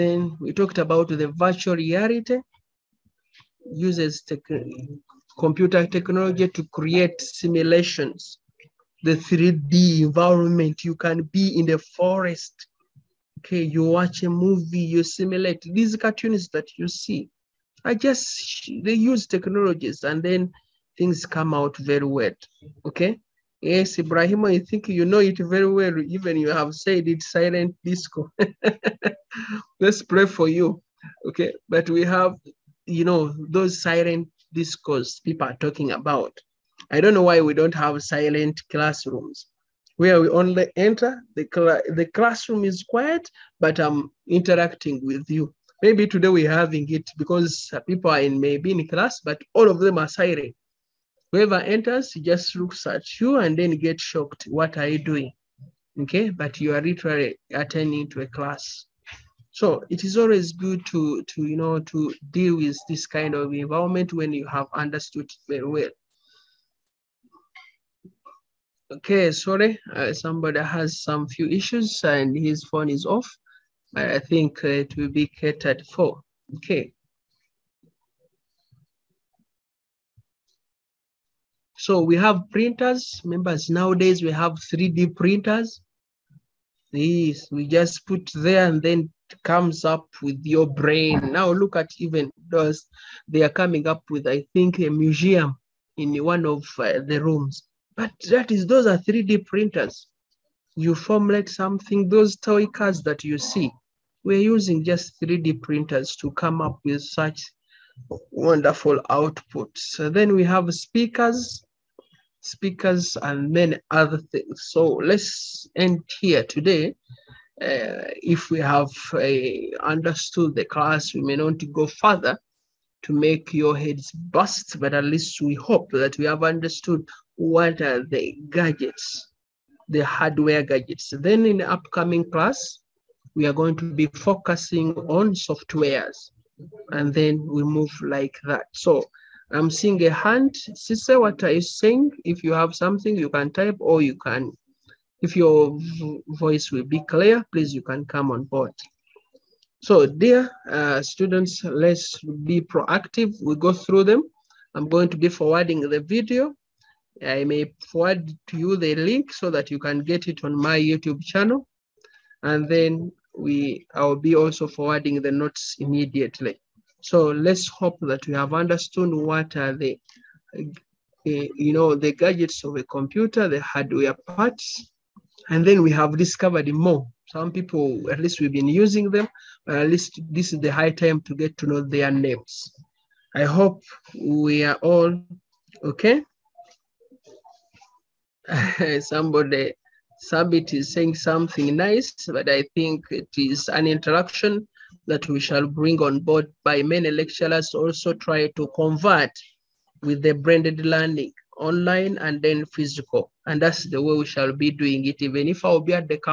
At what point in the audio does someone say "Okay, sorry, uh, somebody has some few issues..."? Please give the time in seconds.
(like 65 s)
68 s.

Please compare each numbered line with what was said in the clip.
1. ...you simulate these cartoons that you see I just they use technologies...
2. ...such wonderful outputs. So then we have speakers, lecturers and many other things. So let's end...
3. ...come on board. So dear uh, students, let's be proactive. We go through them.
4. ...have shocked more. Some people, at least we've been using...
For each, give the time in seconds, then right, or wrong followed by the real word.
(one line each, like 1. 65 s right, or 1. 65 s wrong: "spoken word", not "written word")
1. 14 s right
2. 107 s wrong: "speakers", not "lecturers"
3. 148 s right
4. 175 s wrong: "discovered", not "shocked".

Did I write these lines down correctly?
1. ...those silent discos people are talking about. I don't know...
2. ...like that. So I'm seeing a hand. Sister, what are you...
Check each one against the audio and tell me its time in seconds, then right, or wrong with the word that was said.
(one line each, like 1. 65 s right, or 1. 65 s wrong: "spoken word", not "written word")
1. 33 s right
2. 138 s right.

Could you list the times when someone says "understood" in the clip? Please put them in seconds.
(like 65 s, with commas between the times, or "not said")
64 s, 119 s, 126 s, 168 s.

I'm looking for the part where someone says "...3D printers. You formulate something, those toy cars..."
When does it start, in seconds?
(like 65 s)
98 s.